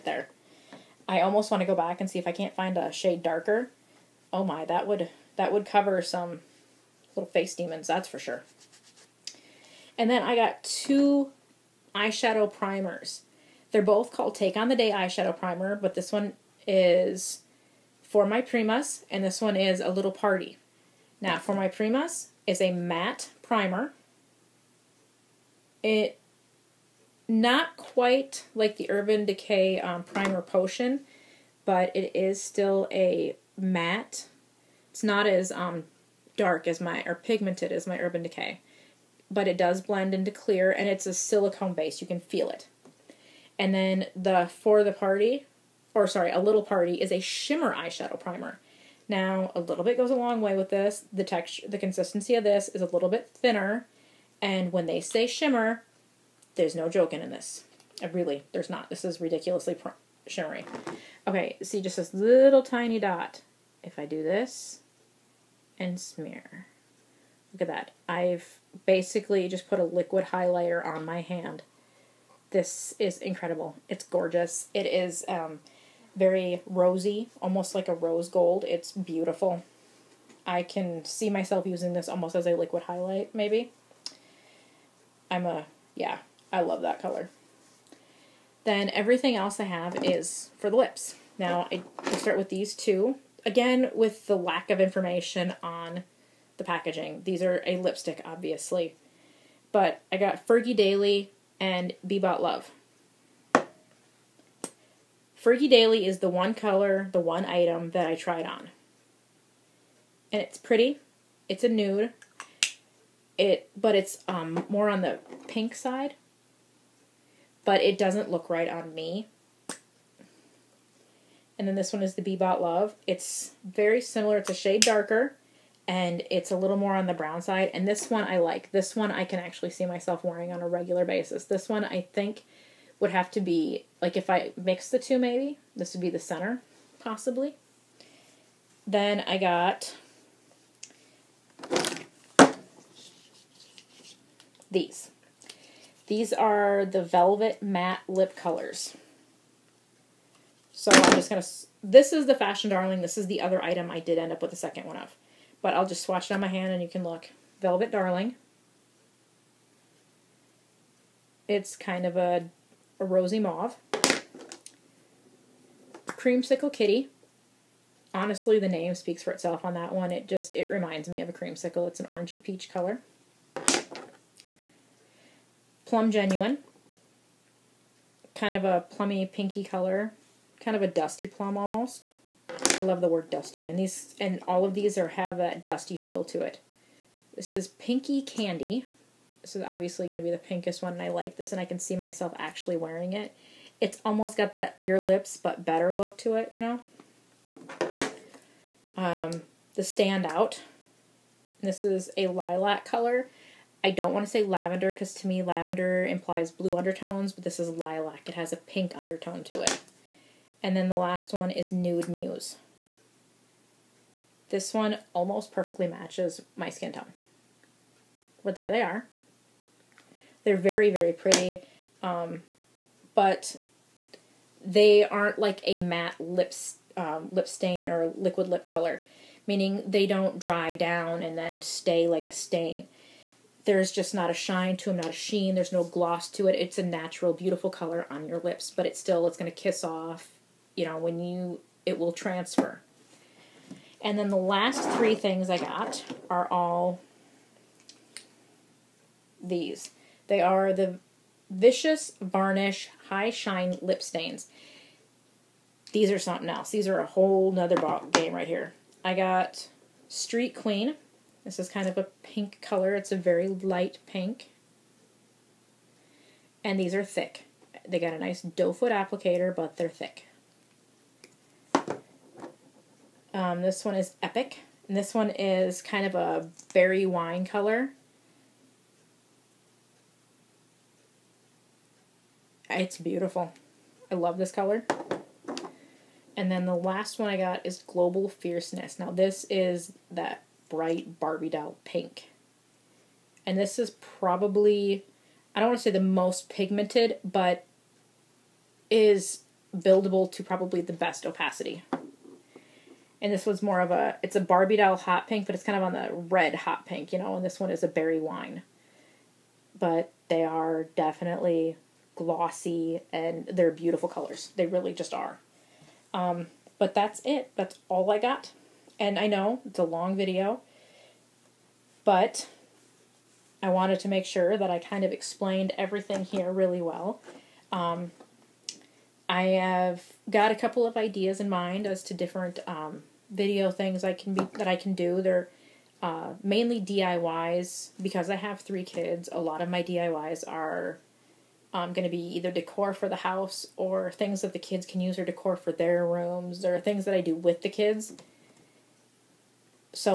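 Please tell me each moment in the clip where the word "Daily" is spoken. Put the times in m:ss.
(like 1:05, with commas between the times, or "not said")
1:40, 1:45.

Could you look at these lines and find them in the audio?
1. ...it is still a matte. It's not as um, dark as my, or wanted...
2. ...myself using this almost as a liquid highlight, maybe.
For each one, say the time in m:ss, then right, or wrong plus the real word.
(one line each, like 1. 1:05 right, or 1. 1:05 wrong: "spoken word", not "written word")
1. 0:31 wrong: "pigmented", not "wanted"
2. 1:21 right.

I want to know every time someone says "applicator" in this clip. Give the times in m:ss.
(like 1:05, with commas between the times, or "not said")
4:28.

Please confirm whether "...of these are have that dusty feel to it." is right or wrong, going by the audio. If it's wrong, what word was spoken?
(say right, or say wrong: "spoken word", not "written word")
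right.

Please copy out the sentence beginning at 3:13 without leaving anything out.
It's almost got that your lips, but better look to it, you know?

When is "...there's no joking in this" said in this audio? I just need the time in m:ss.
0:56.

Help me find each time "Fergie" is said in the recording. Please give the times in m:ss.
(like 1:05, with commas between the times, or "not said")
1:40, 1:45.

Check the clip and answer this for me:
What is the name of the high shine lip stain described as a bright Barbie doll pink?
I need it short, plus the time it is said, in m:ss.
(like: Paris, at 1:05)
Global Fierceness, at 4:47.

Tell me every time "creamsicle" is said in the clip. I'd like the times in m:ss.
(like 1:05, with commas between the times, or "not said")
2:46, 2:51.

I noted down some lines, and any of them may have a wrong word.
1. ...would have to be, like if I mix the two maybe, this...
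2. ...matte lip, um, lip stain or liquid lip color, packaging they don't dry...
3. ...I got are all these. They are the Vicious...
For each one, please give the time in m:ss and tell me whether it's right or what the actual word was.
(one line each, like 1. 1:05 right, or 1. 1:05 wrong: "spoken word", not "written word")
1. 2:12 right
2. 3:45 wrong: "meaning", not "packaging"
3. 4:05 right.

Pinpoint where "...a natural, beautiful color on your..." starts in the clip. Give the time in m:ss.
3:56.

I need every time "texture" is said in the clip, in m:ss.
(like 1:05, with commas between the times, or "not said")
0:51.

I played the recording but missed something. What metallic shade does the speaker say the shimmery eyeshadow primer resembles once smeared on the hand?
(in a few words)
rose gold.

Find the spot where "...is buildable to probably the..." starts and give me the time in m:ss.
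4:58.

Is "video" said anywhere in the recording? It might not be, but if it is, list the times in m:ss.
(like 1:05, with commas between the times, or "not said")
5:20, 5:33.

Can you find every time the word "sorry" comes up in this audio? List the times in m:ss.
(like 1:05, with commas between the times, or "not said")
0:46.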